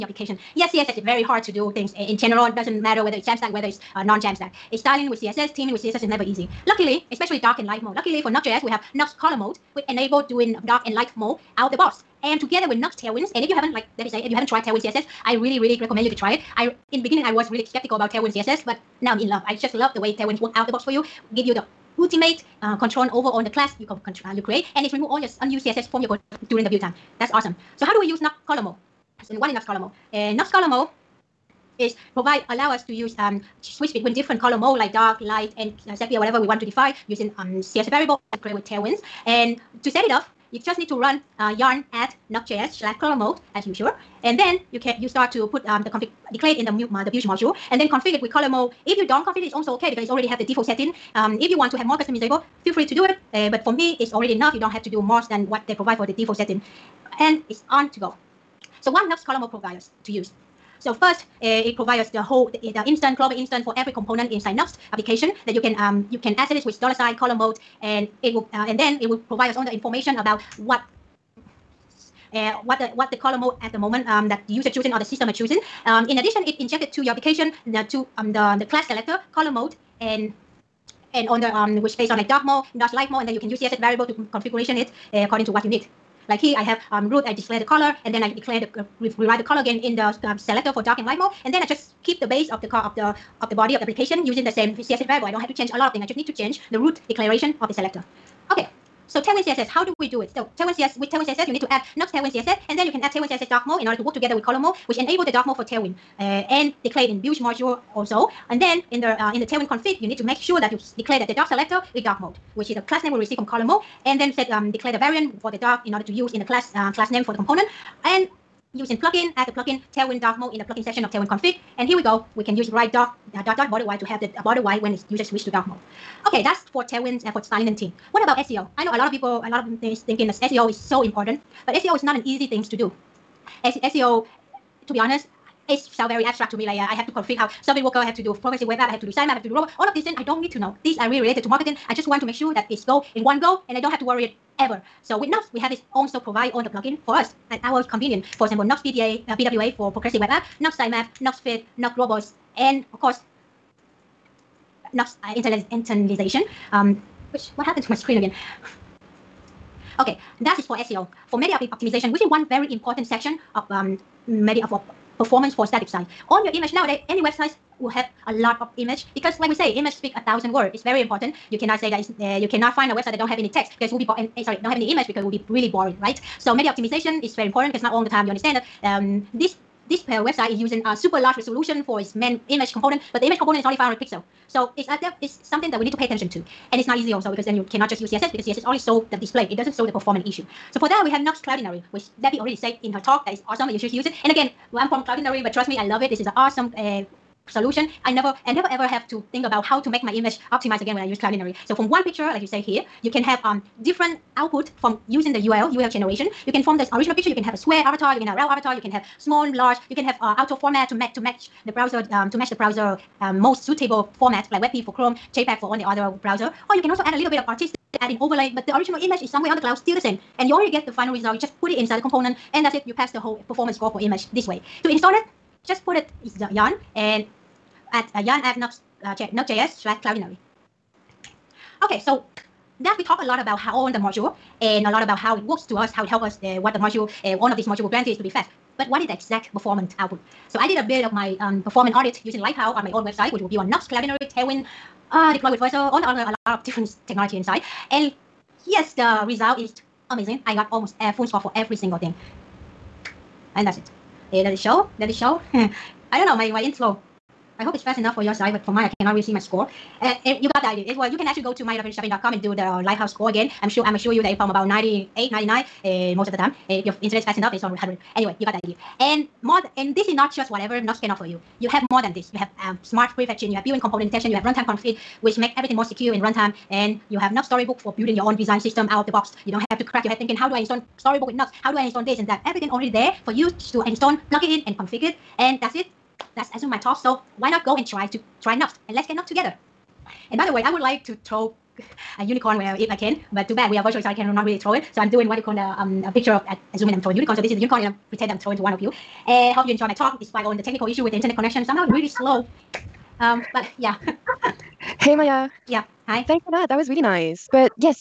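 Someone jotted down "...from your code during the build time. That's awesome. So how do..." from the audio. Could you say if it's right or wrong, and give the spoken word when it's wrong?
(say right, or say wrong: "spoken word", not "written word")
right.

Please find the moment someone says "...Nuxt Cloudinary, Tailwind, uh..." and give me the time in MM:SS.
04:03.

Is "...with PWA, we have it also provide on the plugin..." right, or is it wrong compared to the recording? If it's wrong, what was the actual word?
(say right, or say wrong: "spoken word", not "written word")
wrong: "Nuxt", not "PWA".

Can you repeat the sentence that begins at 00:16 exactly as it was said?
I in beginning I was really skeptical about Tailwind CSS, but now I'm in love.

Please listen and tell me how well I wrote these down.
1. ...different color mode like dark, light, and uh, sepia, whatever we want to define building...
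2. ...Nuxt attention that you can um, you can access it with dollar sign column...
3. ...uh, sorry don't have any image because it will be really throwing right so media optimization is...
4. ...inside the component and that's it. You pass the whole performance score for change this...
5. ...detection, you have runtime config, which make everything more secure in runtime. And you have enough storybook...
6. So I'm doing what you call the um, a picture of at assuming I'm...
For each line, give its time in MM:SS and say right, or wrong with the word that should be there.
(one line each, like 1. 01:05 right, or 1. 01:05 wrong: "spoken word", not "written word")
1. 00:34 wrong: "using", not "building"
2. 01:04 wrong: "application", not "attention"
3. 02:54 wrong: "boring", not "throwing"
4. 03:41 wrong: "image", not "change"
5. 04:34 right
6. 04:54 right.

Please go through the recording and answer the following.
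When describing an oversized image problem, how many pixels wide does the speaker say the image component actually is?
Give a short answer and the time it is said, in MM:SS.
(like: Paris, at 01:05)
500, at 03:03.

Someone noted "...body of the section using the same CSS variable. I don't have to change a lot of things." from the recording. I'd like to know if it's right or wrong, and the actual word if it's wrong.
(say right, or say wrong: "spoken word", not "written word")
wrong: "application", not "section".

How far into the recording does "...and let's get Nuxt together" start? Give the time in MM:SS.
04:48.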